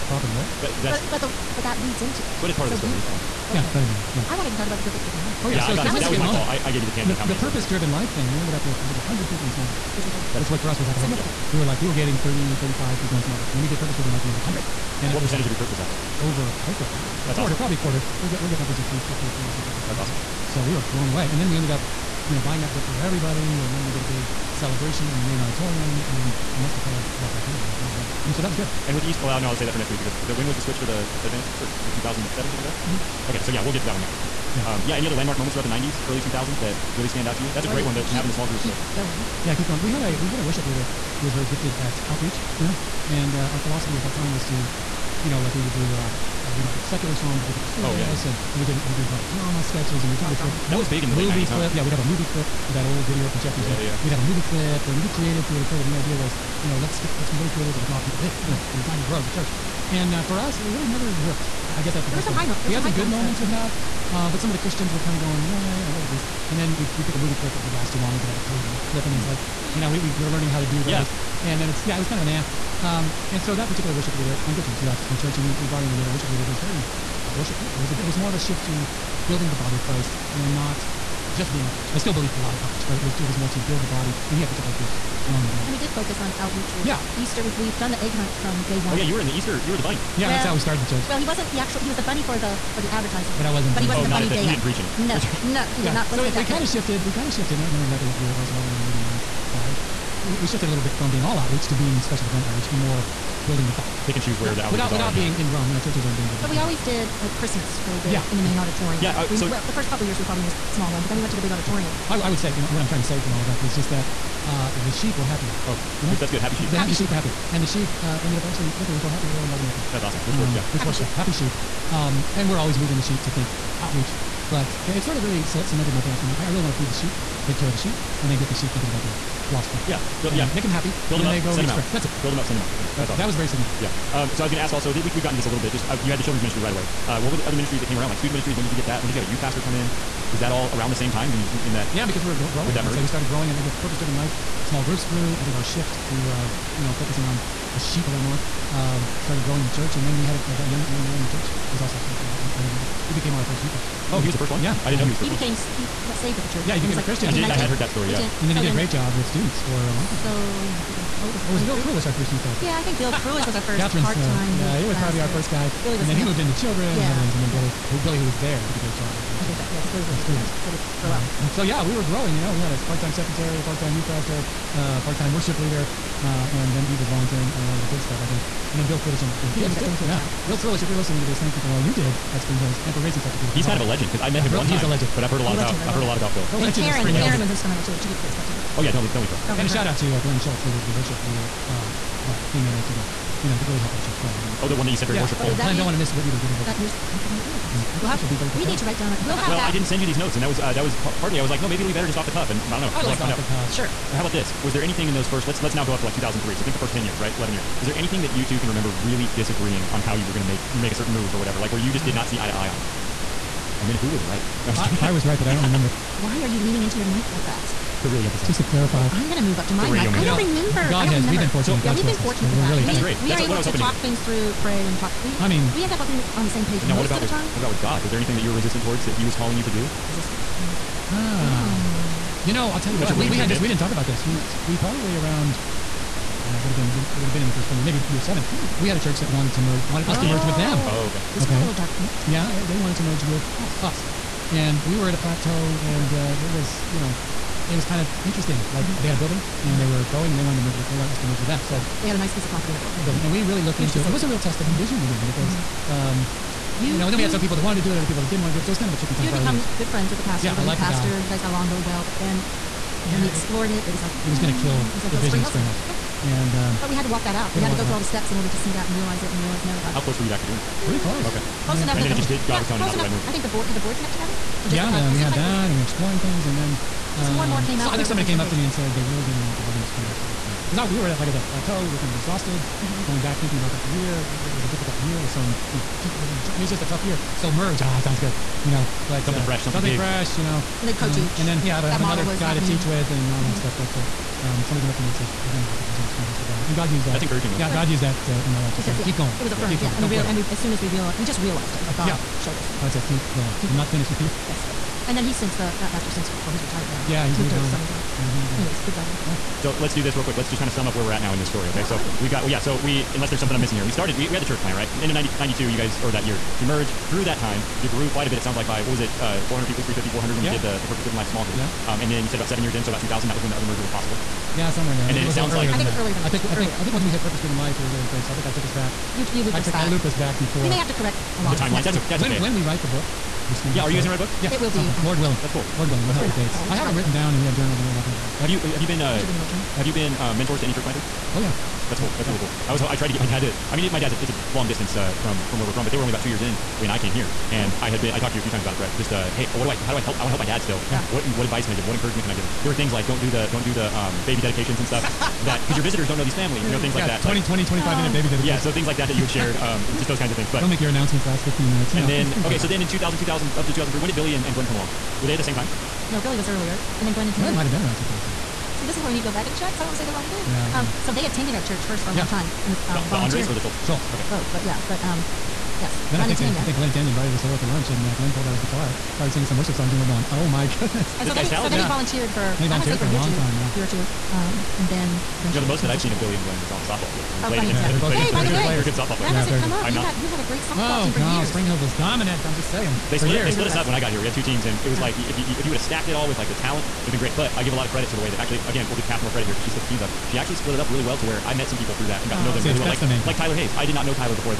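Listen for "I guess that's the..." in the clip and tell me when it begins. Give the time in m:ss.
1:01.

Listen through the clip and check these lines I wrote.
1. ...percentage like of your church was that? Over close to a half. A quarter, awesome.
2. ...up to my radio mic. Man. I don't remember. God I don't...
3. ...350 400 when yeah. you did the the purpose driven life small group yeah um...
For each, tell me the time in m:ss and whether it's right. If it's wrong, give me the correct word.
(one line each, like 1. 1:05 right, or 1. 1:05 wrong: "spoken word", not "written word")
1. 0:15 right
2. 3:39 right
3. 5:19 right.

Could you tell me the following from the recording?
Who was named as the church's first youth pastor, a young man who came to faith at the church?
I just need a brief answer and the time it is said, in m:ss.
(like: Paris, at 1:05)
Billy Andre, at 2:32.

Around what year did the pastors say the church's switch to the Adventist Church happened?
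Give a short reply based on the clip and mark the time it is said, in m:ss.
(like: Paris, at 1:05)
2007, at 0:31.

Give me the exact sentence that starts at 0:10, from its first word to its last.
That's which what for us was like a significant.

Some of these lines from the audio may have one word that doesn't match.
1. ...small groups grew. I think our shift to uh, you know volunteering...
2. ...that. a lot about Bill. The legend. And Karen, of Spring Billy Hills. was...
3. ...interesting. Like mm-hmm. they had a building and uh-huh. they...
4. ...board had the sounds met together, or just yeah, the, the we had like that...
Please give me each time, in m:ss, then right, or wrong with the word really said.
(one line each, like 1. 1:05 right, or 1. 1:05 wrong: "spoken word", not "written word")
1. 2:24 wrong: "focusing", not "volunteering"
2. 3:06 wrong: "Karen", not "Billy"
3. 4:08 right
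4. 4:33 wrong: "boards", not "sounds".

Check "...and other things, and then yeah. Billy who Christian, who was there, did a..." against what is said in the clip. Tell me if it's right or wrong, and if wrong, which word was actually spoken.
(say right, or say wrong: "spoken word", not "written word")
wrong: "Billy", not "Christian".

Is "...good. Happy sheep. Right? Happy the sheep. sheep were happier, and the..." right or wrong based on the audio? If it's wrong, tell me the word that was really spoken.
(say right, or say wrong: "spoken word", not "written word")
right.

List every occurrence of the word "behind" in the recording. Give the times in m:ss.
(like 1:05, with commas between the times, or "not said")
not said.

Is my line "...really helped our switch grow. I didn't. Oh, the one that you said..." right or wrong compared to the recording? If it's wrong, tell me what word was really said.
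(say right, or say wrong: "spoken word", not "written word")
wrong: "church", not "switch".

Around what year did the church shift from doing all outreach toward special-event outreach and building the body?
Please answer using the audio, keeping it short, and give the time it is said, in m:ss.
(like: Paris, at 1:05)
1995, at 1:38.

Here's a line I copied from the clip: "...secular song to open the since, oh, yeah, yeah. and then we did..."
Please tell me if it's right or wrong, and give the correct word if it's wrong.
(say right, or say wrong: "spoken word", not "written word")
wrong: "service", not "since".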